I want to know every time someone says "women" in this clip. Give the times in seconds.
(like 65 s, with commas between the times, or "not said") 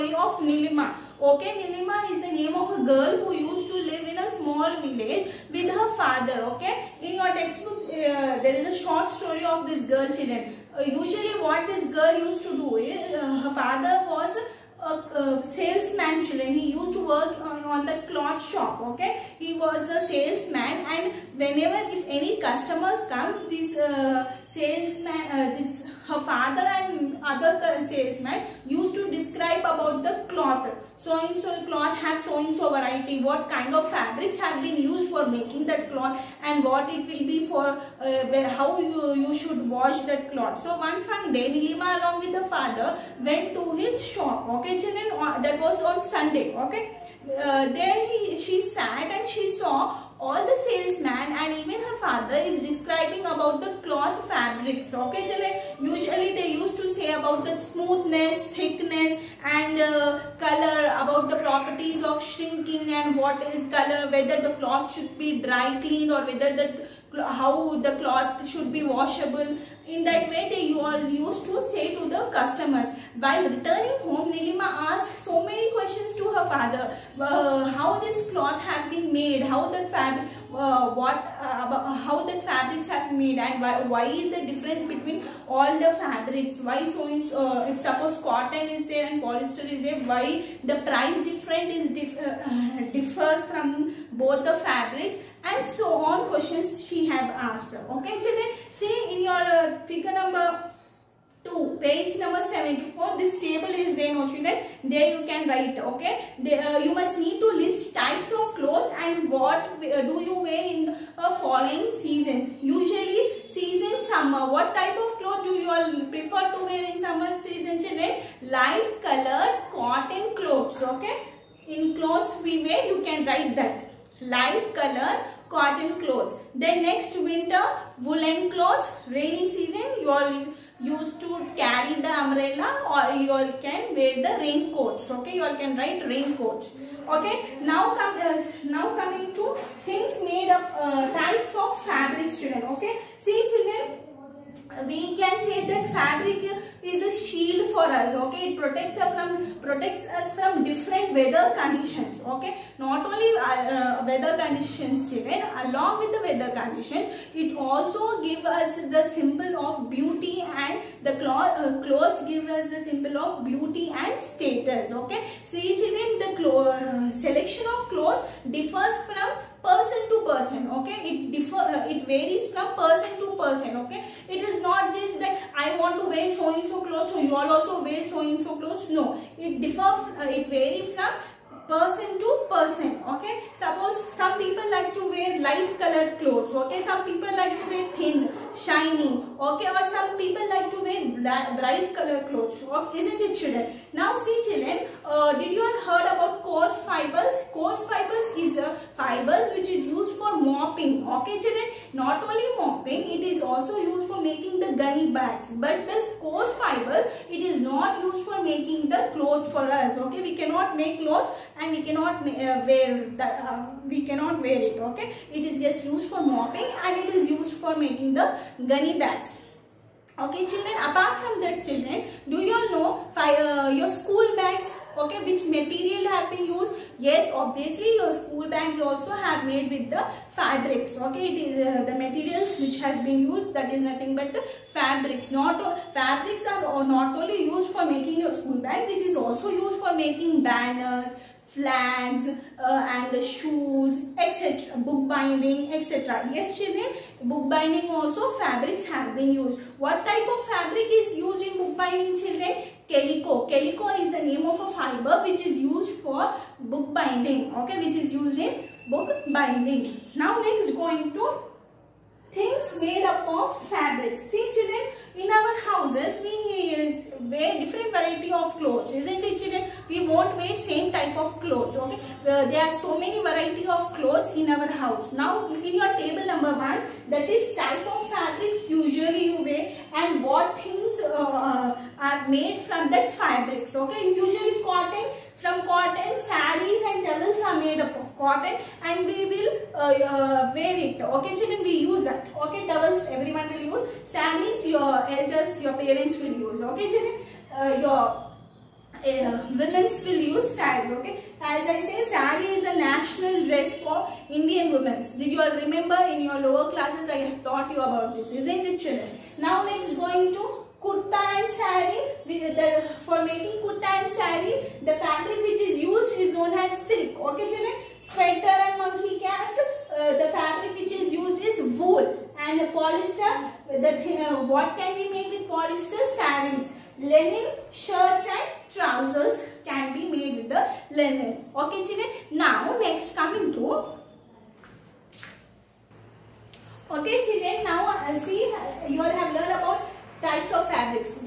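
299 s, 304 s.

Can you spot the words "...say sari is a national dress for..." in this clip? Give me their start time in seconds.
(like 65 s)
301 s.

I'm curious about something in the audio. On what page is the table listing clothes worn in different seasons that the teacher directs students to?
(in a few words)
74.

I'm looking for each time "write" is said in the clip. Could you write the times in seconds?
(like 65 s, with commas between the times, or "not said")
105 s, 123 s, 135 s.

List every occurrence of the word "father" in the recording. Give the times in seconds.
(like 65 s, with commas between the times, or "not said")
5 s, 13 s, 26 s, 42 s, 51 s, 76 s.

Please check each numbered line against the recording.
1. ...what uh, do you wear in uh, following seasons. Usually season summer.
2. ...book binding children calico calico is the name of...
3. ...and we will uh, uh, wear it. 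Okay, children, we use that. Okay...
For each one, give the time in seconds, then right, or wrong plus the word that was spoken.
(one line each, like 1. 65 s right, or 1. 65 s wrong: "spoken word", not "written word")
1. 109 s right
2. 251 s right
3. 288 s right.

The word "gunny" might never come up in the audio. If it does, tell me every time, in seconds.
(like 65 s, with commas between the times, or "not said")
204 s, 218 s.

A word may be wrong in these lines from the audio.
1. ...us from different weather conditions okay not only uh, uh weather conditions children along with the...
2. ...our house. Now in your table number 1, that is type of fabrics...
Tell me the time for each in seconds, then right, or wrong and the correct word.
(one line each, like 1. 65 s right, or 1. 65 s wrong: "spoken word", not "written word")
1. 150 s right
2. 274 s right.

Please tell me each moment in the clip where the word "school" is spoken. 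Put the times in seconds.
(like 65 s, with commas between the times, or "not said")
223 s, 228 s, 238 s.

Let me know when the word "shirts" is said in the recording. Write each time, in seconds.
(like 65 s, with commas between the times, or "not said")
327 s.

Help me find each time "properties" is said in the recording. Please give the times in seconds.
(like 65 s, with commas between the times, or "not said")
61 s.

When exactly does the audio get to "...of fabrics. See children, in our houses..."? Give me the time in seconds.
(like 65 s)
263 s.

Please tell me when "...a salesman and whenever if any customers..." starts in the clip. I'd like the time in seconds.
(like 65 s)
19 s.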